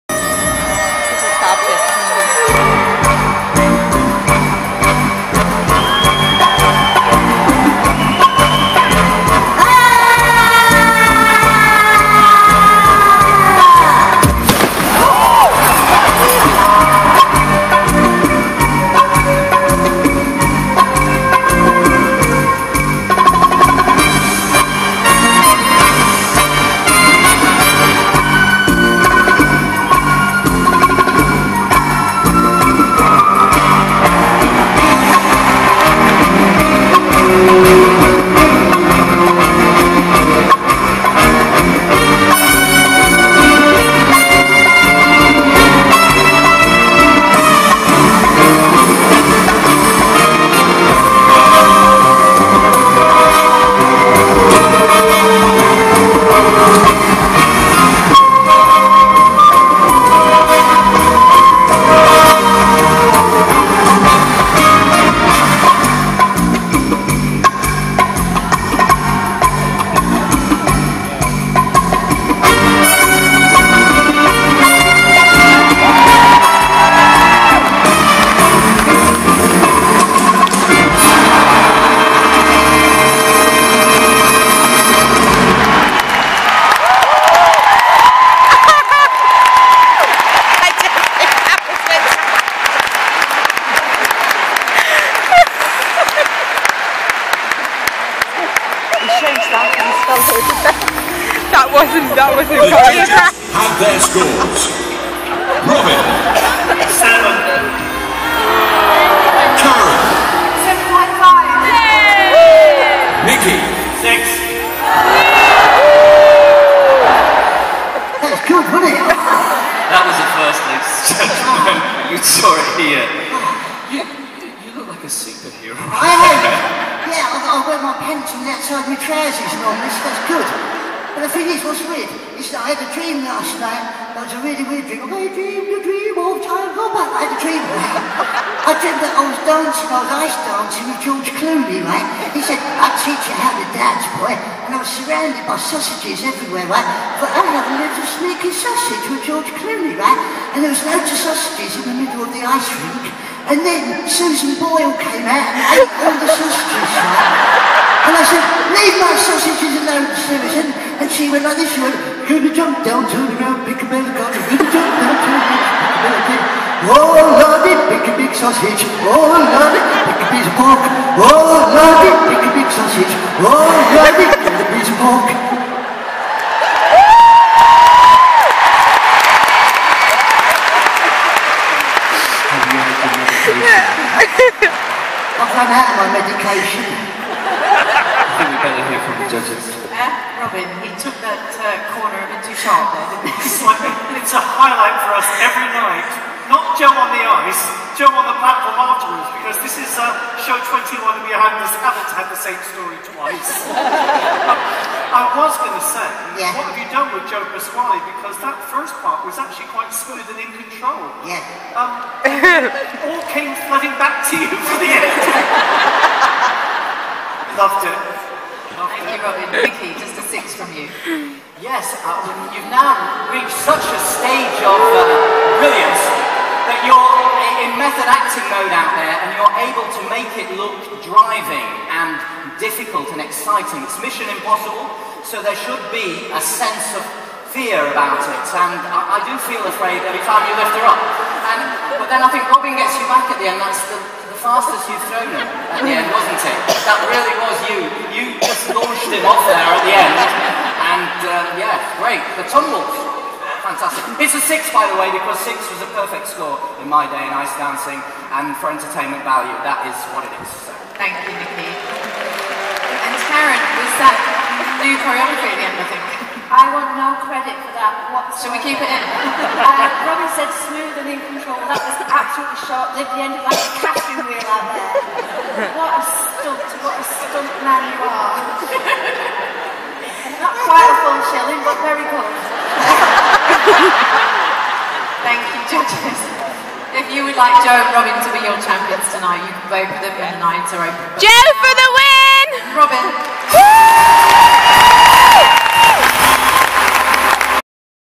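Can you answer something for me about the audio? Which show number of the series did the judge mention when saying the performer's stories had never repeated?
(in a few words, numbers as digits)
21.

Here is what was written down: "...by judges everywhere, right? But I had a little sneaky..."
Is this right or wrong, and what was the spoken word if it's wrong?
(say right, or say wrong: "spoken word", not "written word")
wrong: "sausages", not "judges".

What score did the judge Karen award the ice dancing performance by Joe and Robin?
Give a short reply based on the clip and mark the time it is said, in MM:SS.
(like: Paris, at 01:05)
7.5, at 01:50.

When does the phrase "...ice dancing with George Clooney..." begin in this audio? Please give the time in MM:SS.
02:20.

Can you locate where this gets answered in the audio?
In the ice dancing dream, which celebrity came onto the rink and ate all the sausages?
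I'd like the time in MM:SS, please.
02:34.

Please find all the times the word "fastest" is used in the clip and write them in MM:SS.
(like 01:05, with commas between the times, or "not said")
04:04.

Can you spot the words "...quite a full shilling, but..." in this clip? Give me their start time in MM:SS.
04:40.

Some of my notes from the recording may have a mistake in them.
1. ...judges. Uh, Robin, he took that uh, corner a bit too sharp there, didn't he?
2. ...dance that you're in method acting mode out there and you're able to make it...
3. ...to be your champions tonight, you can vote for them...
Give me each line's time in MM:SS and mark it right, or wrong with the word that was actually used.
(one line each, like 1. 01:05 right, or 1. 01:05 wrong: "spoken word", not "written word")
1. 03:09 right
2. 03:45 wrong: "brilliance", not "dance"
3. 04:48 right.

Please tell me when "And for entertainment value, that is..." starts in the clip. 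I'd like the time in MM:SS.
04:18.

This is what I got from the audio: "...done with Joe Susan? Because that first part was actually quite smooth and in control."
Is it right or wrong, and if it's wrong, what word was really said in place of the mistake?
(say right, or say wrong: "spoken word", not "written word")
wrong: "Pasquale", not "Susan".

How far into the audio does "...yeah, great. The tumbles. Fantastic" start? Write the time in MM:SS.
04:11.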